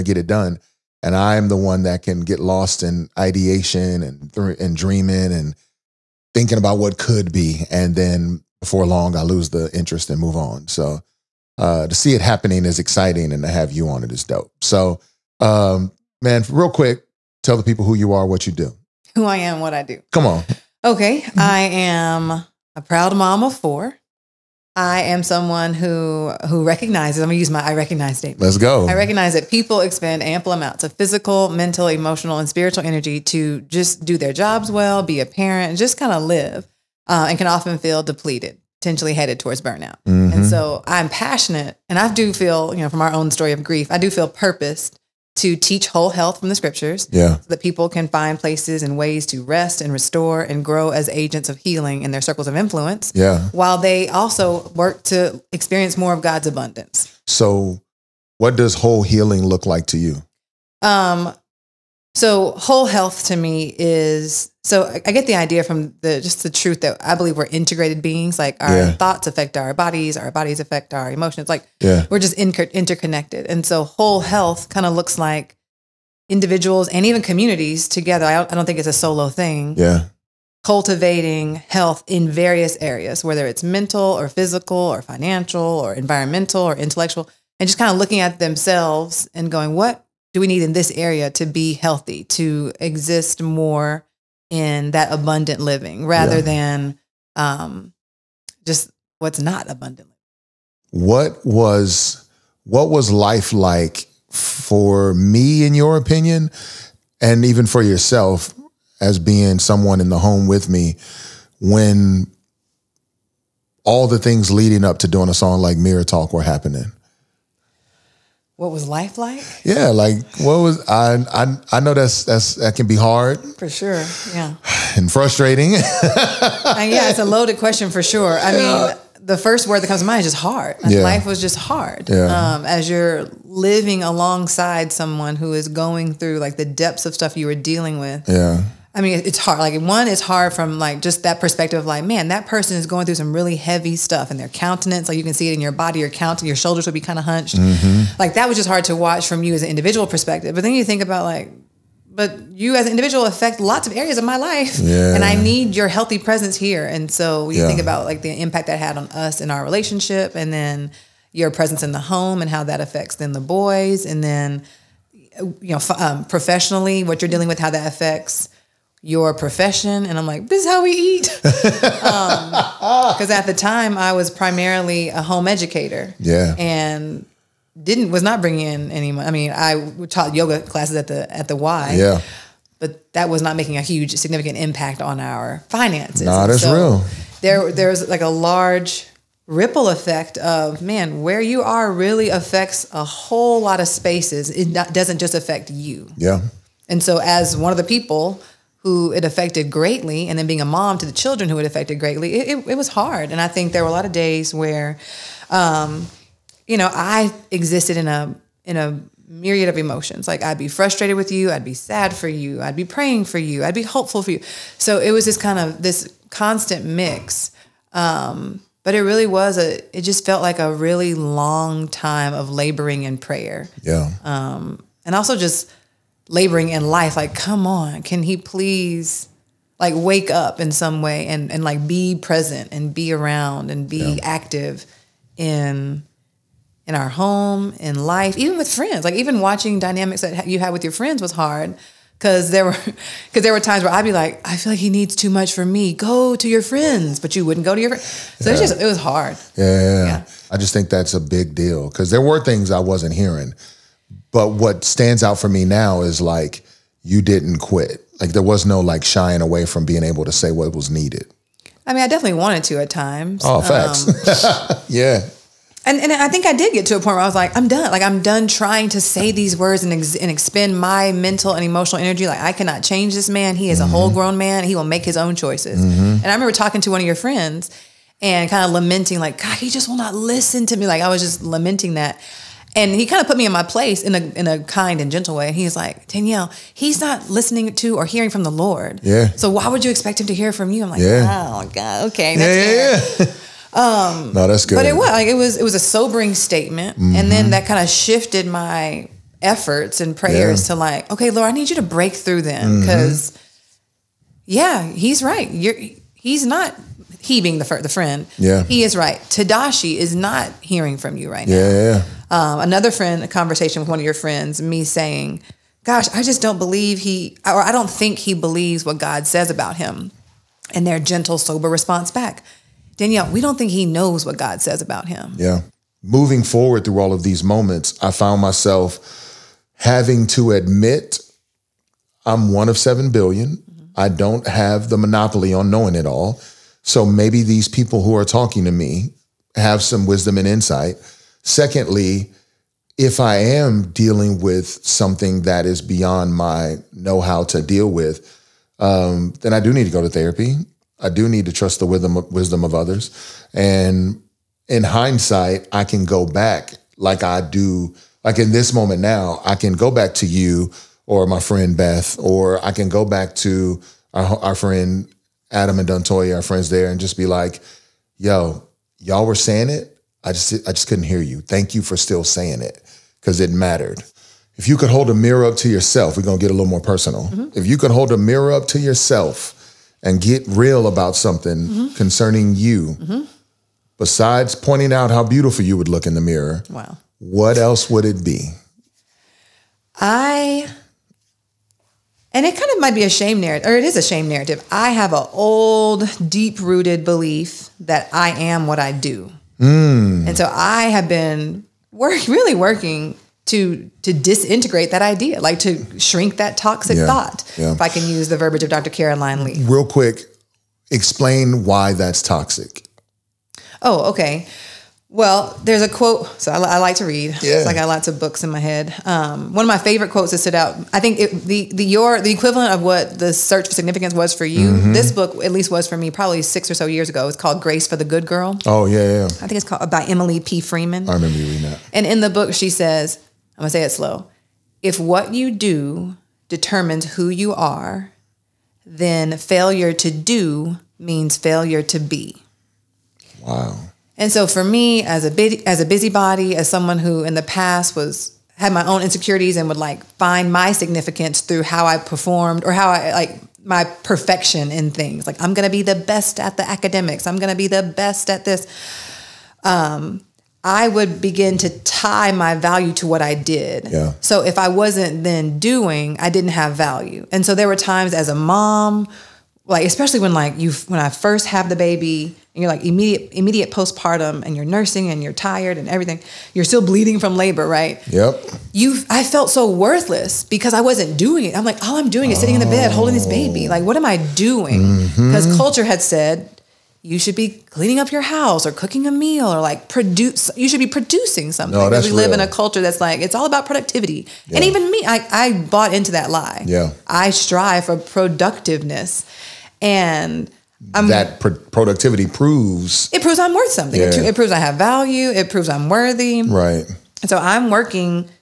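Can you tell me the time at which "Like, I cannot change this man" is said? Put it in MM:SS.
04:32.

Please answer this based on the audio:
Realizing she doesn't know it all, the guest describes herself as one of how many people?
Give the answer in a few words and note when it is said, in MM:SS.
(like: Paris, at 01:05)
7 billion, at 05:32.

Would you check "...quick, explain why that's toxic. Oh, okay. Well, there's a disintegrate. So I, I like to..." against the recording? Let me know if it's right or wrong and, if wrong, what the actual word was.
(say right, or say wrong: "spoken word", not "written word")
wrong: "quote", not "disintegrate".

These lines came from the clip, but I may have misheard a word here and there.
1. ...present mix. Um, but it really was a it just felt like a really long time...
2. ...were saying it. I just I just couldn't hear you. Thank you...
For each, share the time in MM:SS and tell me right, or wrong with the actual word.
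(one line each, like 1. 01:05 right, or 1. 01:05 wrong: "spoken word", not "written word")
1. 03:36 wrong: "constant", not "present"
2. 06:09 right.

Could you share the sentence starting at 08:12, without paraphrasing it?
in a culture that's like it's all about productivity yeah.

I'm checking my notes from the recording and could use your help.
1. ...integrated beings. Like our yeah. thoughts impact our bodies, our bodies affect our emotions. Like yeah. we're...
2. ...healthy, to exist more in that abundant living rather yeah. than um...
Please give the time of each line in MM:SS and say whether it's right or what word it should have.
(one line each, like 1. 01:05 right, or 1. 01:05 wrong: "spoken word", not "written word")
1. 01:07 wrong: "affect", not "impact"
2. 01:31 right.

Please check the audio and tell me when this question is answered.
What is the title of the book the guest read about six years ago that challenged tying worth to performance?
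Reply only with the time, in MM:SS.
07:07.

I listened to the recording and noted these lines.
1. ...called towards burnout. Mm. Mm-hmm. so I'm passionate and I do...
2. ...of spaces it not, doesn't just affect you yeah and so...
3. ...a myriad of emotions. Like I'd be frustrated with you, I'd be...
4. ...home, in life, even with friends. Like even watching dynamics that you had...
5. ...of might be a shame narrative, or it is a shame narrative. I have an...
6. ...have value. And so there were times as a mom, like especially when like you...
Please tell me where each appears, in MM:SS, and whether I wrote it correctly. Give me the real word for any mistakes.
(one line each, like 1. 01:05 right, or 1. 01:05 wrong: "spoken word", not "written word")
1. 00:39 wrong: "headed", not "called"
2. 03:13 right
3. 03:28 right
4. 03:57 right
5. 06:32 right
6. 07:46 right.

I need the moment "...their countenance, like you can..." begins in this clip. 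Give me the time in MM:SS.
02:24.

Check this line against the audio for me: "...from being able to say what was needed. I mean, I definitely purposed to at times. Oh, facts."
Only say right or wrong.
wrong.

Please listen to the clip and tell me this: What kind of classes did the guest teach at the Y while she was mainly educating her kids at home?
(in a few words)
Yoga.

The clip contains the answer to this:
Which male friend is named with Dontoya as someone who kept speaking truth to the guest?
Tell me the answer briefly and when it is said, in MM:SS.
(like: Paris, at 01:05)
Adam, at 06:05.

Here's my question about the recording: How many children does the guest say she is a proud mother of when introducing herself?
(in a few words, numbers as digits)
4.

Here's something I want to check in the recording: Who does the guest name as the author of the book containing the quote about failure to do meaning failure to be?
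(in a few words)
Emily P. Freeman.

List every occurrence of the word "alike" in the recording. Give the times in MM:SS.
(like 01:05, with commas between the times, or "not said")
not said.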